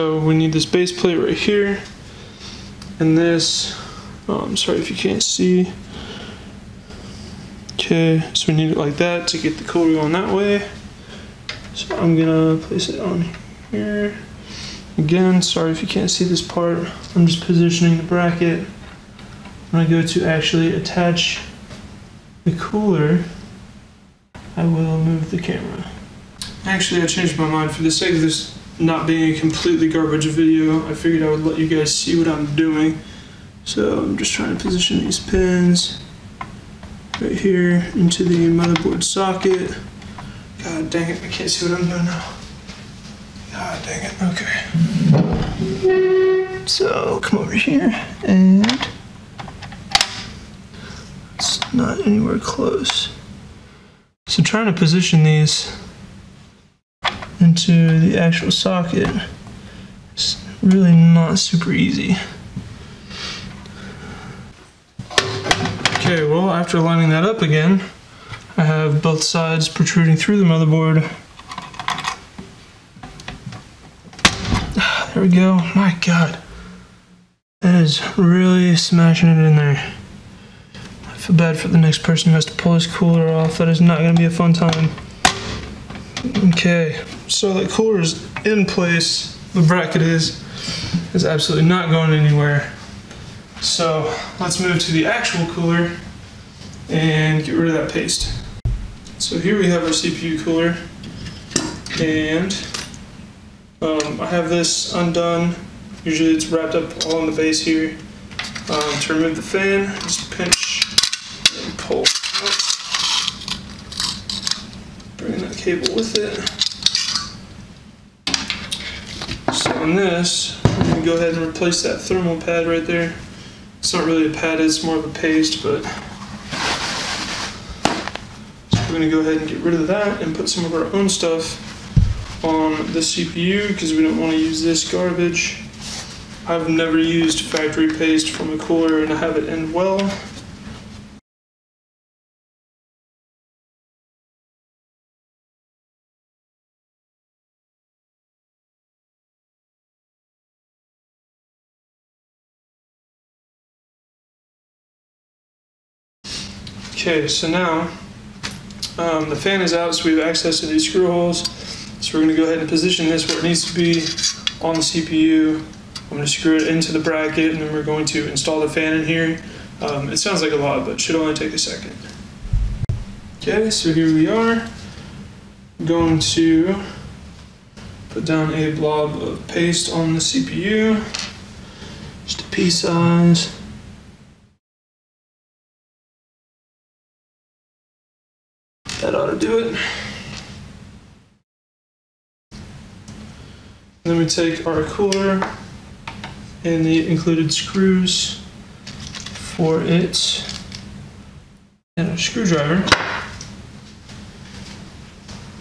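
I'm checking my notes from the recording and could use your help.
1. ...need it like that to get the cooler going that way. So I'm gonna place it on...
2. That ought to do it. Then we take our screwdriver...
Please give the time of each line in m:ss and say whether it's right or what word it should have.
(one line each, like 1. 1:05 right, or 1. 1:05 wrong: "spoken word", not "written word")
1. 0:08 right
2. 3:09 wrong: "cooler", not "screwdriver".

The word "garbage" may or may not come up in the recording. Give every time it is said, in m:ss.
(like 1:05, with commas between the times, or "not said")
0:29, 2:14.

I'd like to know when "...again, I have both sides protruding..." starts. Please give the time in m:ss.
1:07.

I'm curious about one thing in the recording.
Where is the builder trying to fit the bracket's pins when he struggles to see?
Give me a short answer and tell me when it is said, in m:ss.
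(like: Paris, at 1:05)
Motherboard socket, at 0:38.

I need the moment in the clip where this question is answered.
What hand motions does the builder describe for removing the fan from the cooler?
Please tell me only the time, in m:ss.
1:50.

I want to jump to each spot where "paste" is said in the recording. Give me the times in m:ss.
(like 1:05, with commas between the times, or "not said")
1:37, 2:05, 2:17, 2:59.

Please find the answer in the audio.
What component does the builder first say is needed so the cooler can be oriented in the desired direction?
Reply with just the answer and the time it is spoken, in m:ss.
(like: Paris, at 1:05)
Base plate, at 0:00.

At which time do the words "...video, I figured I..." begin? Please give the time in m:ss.
0:30.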